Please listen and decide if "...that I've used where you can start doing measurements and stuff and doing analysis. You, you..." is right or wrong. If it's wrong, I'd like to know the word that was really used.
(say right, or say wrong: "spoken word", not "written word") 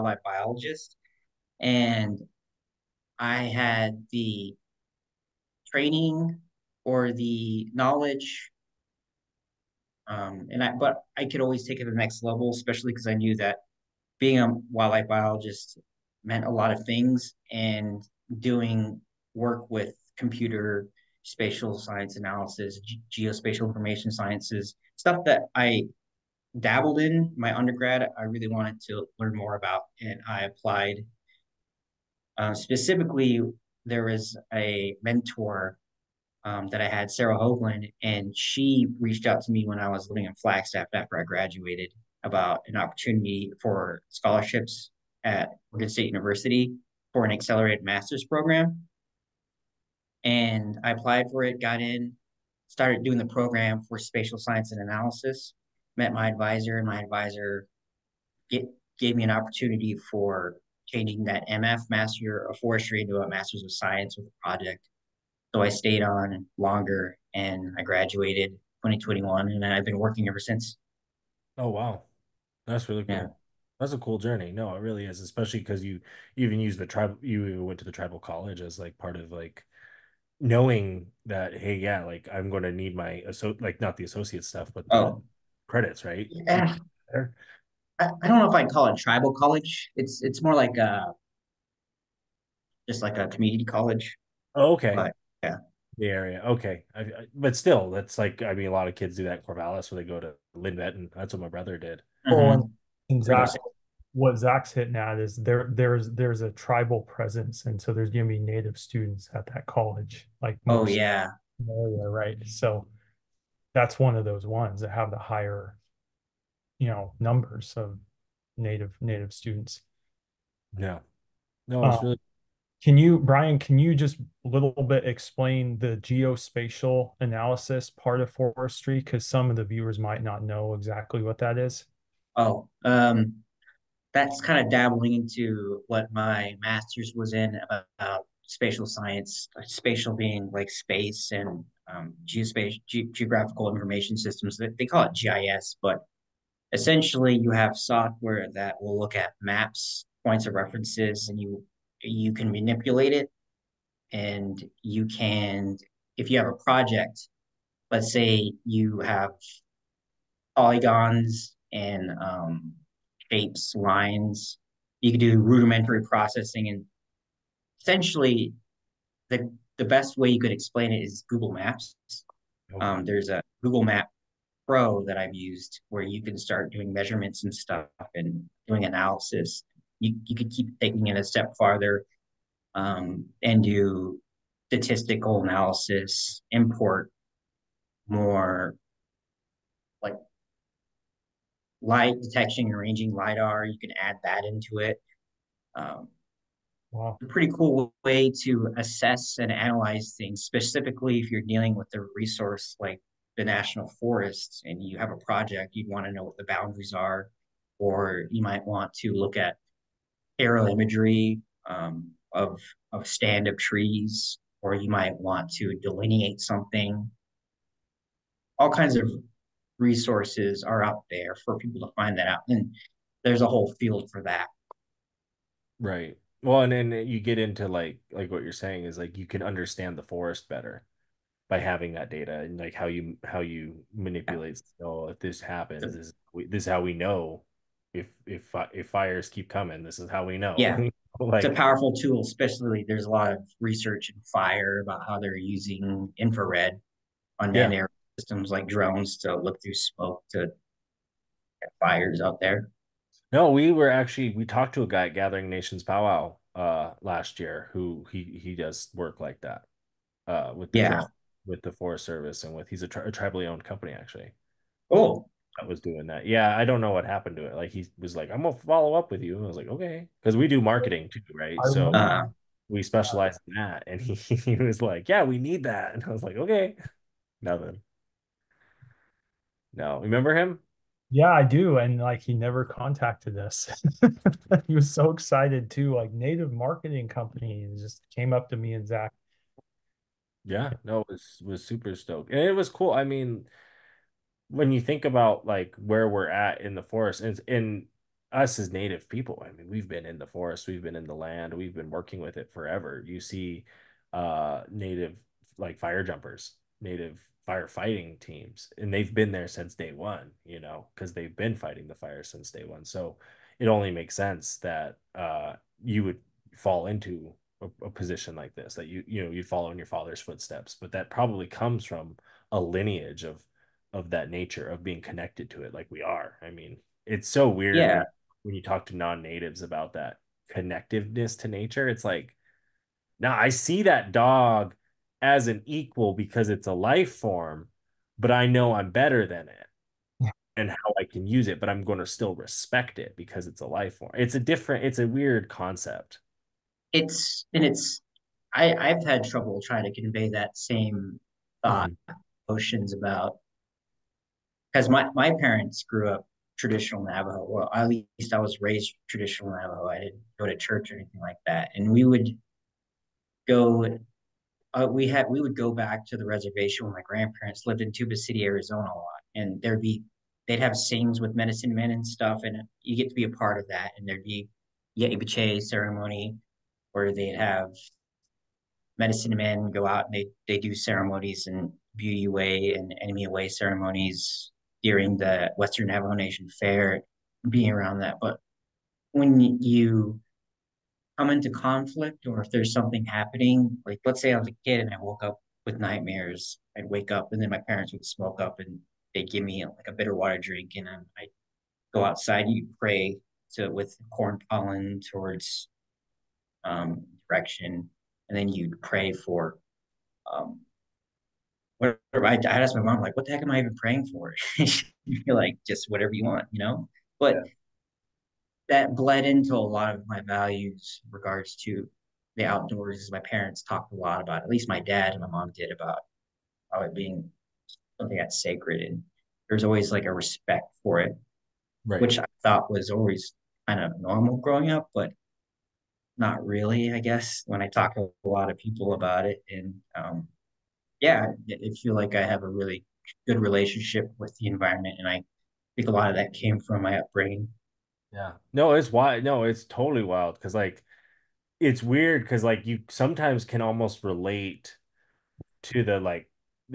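right.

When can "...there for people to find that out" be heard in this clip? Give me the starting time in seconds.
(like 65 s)
221 s.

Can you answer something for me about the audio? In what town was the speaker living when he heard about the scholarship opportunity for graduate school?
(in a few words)
Flagstaff.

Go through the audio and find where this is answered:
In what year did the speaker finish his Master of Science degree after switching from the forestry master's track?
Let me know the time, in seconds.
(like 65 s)
68 s.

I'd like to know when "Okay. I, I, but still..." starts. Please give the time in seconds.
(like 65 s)
96 s.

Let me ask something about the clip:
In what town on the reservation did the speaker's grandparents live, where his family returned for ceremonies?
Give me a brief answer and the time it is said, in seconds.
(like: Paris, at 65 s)
Tuba City, Arizona, at 367 s.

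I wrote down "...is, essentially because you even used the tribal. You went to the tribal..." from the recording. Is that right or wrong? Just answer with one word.
wrong.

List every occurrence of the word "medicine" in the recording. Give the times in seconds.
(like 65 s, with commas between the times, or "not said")
371 s, 378 s.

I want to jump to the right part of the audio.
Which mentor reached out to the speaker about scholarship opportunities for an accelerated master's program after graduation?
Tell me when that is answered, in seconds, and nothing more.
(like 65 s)
37 s.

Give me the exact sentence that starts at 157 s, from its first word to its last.
Let's say you have polygons and um, shapes, lines.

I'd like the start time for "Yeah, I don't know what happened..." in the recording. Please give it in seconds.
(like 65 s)
266 s.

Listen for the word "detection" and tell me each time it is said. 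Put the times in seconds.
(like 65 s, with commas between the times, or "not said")
192 s.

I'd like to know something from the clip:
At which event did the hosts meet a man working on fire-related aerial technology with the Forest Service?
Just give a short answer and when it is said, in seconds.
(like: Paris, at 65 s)
Gathering Nations Powwow, at 255 s.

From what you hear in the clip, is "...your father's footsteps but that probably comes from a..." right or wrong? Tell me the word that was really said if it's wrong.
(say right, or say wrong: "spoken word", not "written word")
right.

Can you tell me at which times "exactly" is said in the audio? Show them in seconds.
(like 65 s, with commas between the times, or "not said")
130 s.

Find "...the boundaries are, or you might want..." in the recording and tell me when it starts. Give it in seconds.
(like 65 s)
206 s.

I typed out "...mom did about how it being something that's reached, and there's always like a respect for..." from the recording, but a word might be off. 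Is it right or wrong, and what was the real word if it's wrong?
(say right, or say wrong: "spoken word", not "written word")
wrong: "sacred", not "reached".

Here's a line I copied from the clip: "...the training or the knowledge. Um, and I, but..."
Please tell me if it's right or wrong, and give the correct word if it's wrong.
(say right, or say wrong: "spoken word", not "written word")
right.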